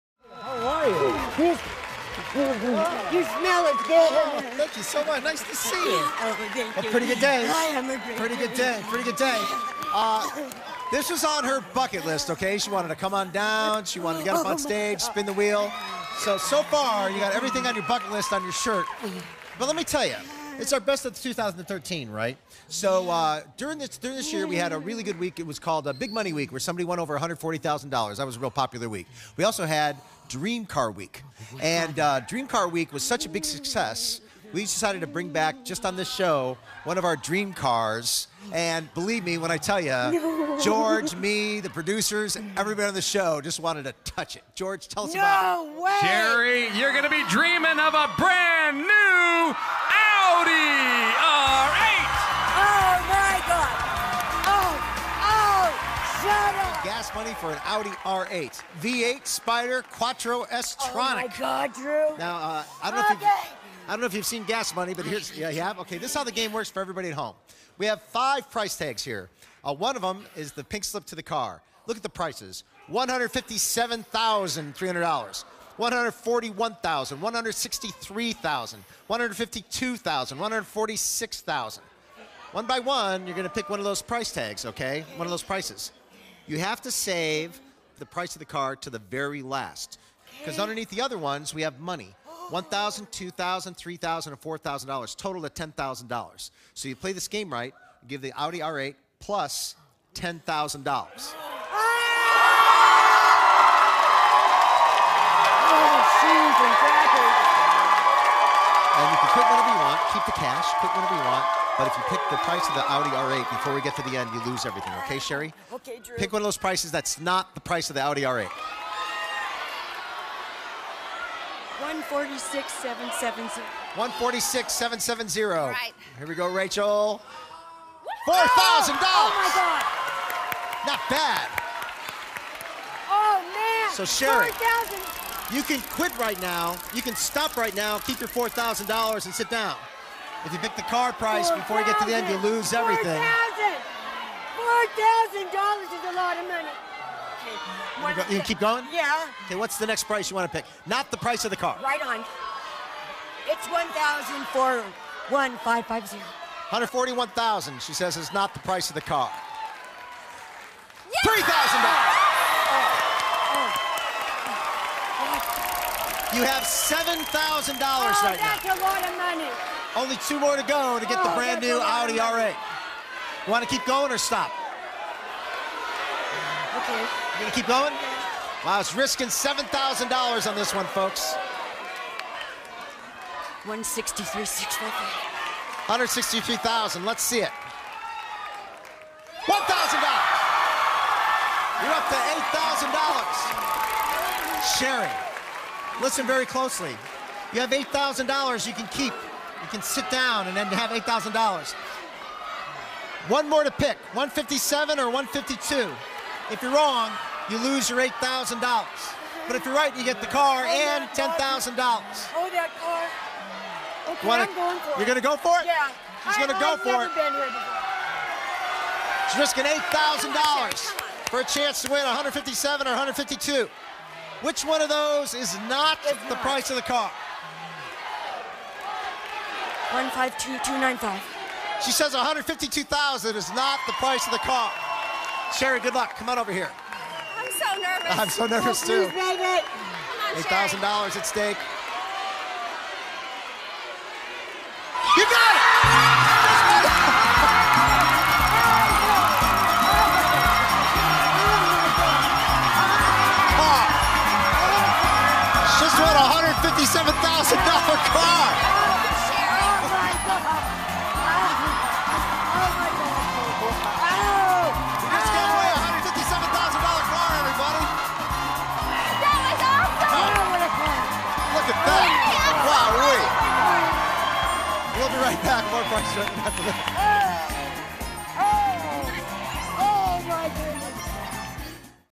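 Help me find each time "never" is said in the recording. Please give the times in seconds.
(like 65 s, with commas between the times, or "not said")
216 s.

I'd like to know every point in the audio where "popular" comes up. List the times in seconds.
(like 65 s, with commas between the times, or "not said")
28 s.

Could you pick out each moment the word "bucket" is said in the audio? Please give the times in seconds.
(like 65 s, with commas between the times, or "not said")
11 s, 17 s.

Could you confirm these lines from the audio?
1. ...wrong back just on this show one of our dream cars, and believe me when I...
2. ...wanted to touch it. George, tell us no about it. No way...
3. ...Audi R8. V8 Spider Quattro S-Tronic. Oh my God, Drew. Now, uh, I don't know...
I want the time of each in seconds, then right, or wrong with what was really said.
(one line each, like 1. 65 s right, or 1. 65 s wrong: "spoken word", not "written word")
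1. 35 s wrong: "bring", not "wrong"
2. 43 s right
3. 57 s right.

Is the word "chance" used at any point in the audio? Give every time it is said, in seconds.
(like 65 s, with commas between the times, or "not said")
221 s.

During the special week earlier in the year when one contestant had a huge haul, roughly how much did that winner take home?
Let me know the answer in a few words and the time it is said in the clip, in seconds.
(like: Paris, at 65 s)
over $140,000, at 26 s.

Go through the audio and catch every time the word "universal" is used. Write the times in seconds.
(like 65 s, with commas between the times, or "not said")
not said.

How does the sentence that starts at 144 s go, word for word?
4000 $4,000 is a lot of money.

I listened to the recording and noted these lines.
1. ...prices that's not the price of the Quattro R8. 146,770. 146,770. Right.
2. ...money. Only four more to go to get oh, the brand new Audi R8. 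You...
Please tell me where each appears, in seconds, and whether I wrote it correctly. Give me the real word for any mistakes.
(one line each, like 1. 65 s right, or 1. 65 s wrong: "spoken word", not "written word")
1. 116 s wrong: "Audi", not "Quattro"
2. 169 s wrong: "two", not "four".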